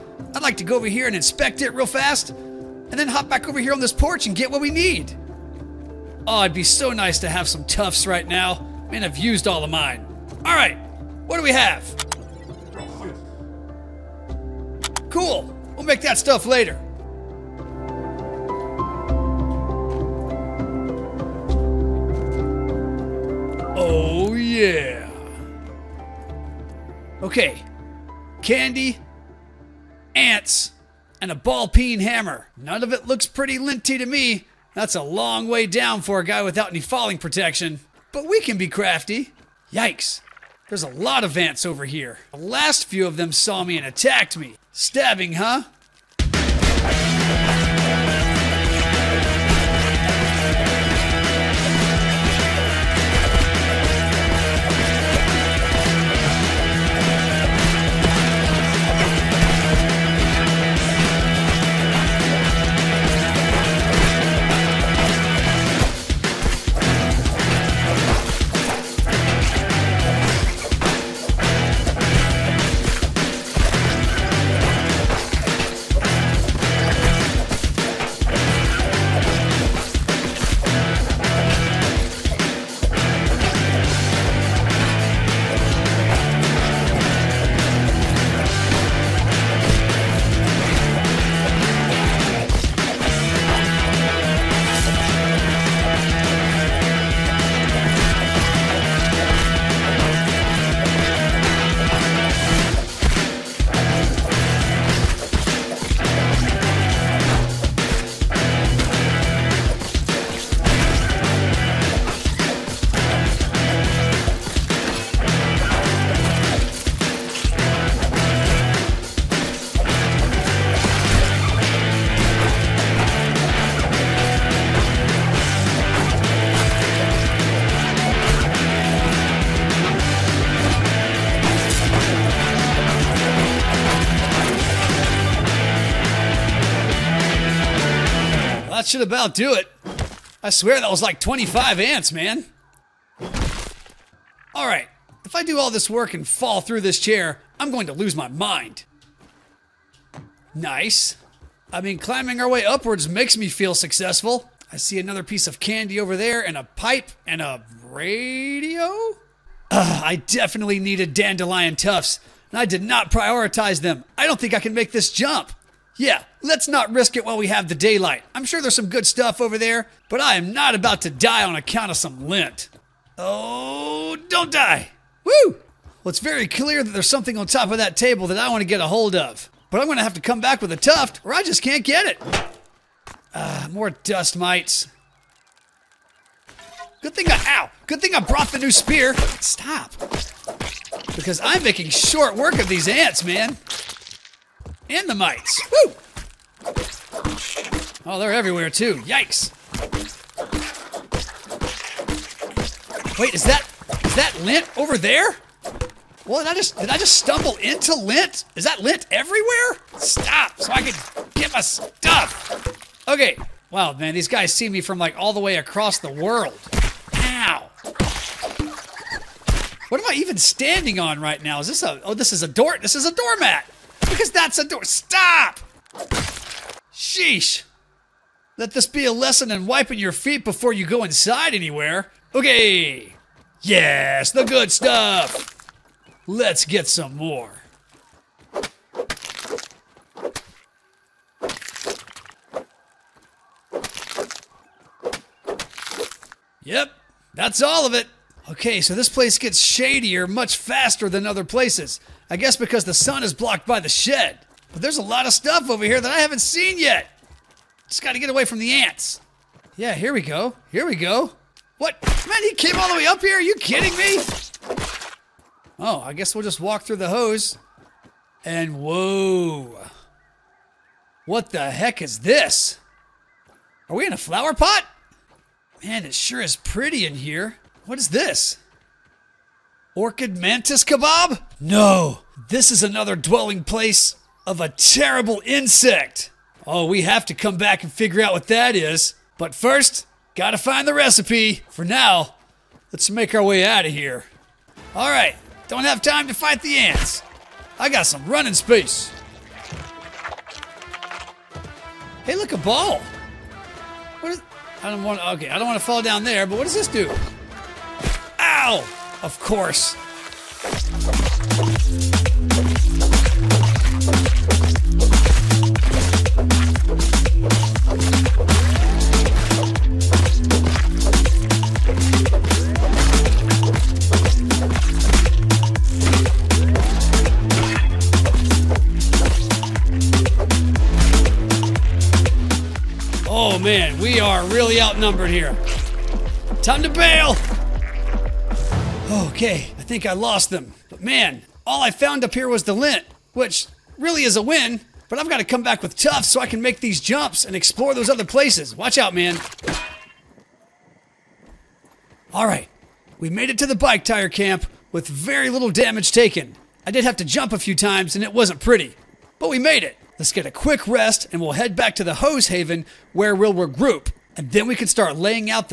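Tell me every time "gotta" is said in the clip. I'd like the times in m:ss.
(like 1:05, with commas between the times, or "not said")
4:18, 4:50.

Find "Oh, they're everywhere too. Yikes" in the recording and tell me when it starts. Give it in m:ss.
3:18.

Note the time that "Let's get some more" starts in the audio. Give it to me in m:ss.
3:56.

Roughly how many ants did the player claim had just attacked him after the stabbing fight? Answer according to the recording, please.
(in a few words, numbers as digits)
25.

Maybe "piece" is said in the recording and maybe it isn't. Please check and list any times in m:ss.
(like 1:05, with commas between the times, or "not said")
2:35.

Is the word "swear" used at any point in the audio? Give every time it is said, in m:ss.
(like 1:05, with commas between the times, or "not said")
2:20.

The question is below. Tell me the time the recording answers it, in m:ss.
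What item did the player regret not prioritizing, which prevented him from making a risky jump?
2:41.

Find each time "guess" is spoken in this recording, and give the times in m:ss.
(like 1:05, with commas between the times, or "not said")
4:12, 4:26.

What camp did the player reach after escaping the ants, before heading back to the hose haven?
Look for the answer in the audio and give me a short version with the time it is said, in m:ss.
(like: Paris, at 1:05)
bike tire camp, at 5:53.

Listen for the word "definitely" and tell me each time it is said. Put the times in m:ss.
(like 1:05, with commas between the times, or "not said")
2:40.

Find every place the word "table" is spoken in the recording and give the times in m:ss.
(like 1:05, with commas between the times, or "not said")
2:57.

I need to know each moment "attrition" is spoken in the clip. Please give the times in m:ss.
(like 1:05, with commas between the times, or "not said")
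not said.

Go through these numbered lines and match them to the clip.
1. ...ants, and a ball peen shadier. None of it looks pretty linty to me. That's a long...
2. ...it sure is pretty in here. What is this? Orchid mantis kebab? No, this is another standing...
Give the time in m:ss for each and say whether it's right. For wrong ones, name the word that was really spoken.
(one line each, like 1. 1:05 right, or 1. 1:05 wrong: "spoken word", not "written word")
1. 0:30 wrong: "hammer", not "shadier"
2. 4:36 wrong: "dwelling", not "standing".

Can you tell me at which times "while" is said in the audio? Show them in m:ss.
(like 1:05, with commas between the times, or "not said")
2:47.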